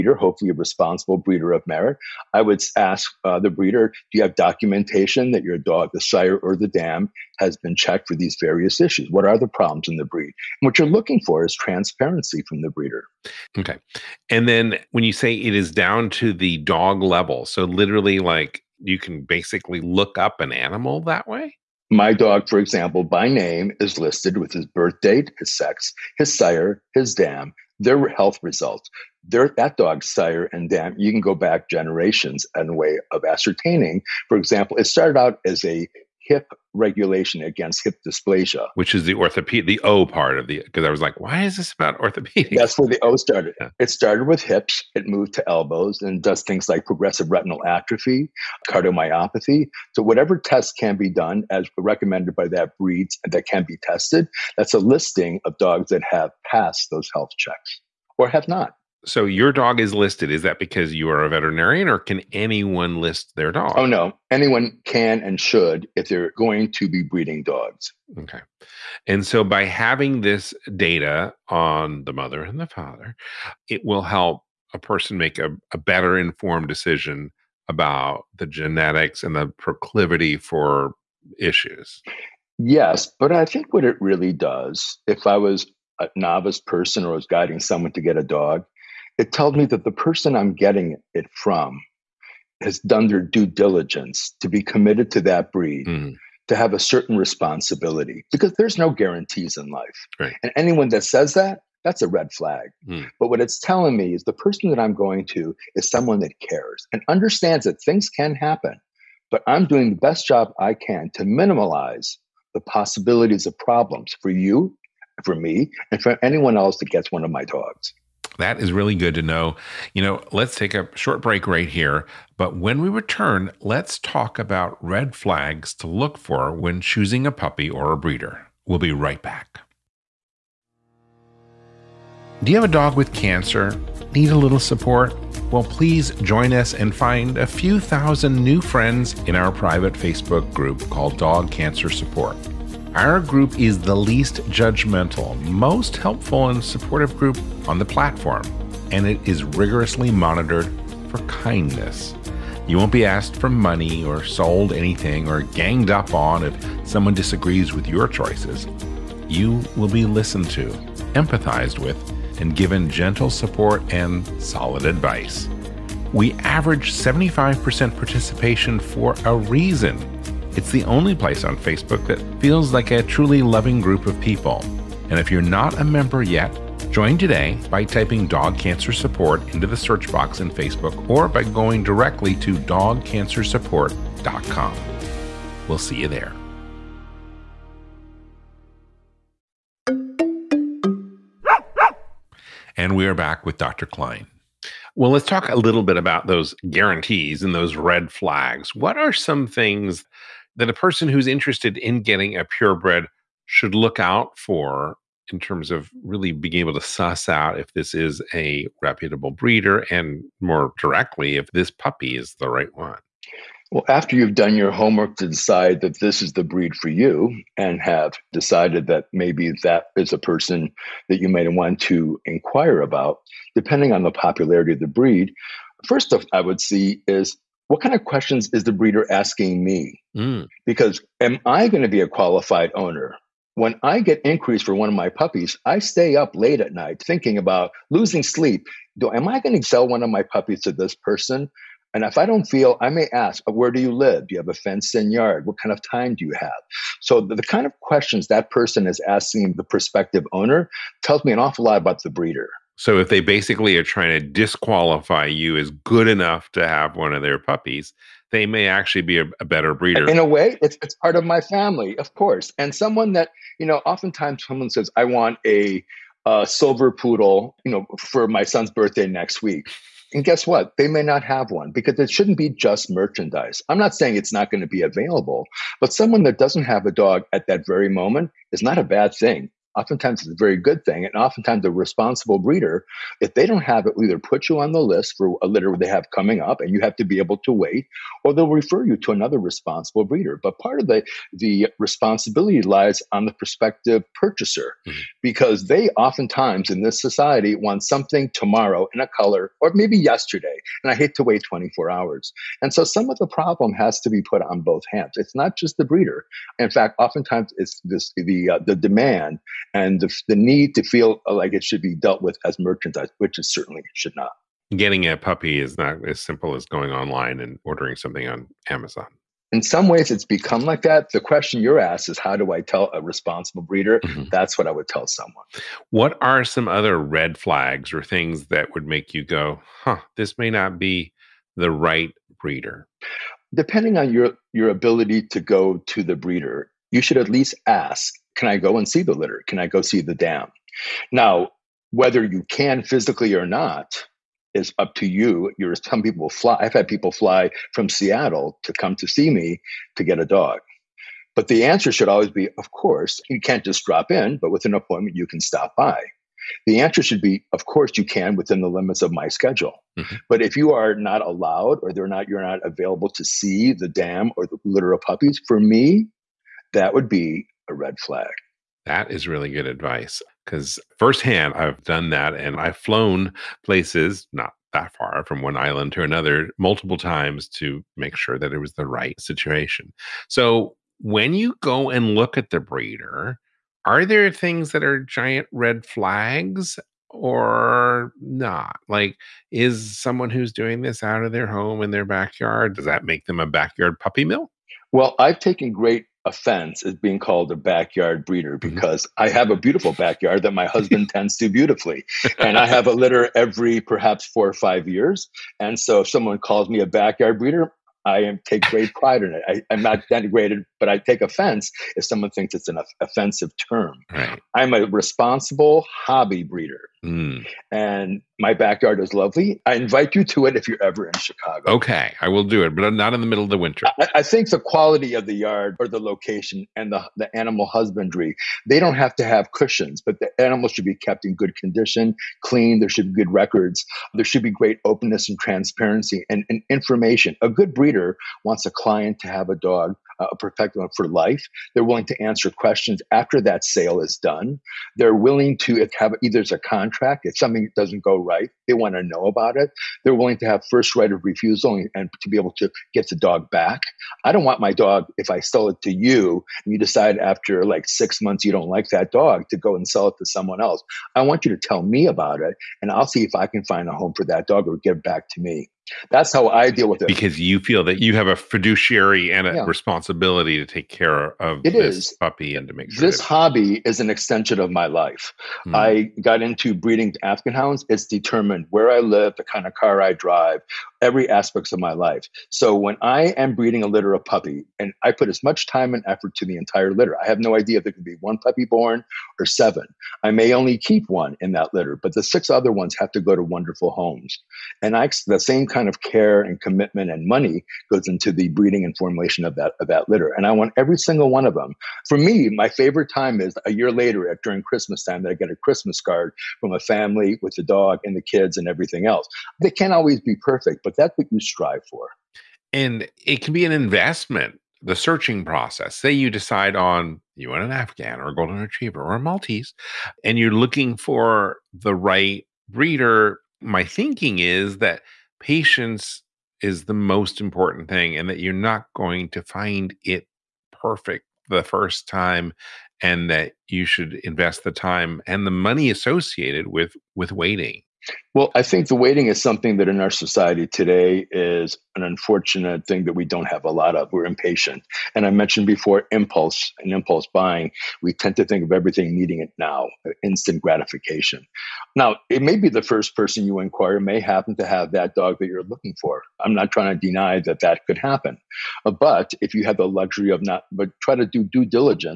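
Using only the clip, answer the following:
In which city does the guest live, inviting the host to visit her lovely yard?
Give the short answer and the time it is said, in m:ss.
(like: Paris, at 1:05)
Chicago, at 7:01.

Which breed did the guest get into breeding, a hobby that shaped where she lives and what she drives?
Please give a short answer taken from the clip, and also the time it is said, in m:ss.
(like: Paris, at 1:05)
Afghan hounds, at 7:57.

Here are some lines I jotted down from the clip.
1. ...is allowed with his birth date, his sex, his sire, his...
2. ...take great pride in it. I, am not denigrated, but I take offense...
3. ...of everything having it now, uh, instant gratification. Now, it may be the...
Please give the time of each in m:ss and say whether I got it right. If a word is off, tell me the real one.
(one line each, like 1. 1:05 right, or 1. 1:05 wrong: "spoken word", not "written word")
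1. 0:23 wrong: "listed", not "allowed"
2. 6:48 right
3. 9:08 wrong: "needing", not "having".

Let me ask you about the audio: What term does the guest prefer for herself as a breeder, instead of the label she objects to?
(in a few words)
Responsible hobby breeder.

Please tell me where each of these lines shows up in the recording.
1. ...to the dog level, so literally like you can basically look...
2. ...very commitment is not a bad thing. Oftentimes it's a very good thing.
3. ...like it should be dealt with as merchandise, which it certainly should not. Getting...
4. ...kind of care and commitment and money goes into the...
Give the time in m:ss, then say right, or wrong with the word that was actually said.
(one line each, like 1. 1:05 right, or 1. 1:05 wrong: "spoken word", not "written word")
1. 0:16 right
2. 4:37 wrong: "moment", not "commitment"
3. 5:11 right
4. 8:15 right.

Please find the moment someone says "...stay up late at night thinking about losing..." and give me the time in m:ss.
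3:55.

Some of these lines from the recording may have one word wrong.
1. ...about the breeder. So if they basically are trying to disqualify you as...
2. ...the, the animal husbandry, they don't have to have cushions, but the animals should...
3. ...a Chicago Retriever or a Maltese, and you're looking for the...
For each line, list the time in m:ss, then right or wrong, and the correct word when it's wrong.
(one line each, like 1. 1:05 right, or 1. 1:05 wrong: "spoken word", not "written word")
1. 4:11 right
2. 7:06 right
3. 8:38 wrong: "Golden", not "Chicago".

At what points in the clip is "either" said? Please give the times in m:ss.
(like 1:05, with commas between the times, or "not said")
4:44, 7:26.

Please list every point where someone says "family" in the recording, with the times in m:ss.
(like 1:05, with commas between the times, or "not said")
4:21, 8:26.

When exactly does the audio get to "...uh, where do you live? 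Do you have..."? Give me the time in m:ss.
4:03.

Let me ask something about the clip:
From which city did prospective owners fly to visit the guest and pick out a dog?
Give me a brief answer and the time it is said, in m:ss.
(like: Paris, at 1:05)
Seattle, at 5:47.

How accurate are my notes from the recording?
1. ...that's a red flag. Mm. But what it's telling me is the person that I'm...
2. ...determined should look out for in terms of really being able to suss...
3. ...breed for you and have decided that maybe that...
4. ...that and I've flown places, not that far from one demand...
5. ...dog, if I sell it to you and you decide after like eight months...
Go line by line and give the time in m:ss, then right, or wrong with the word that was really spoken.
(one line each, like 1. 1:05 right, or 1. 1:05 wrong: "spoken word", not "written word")
1. 1:41 right
2. 3:22 wrong: "purebred", not "determined"
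3. 3:36 right
4. 6:12 wrong: "island", not "demand"
5. 7:34 wrong: "six", not "eight".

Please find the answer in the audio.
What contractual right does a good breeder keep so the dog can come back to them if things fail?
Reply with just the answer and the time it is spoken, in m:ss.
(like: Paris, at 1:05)
First right of refusal, at 7:30.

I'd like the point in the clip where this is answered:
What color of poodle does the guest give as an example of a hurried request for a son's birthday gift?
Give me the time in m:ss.
4:26.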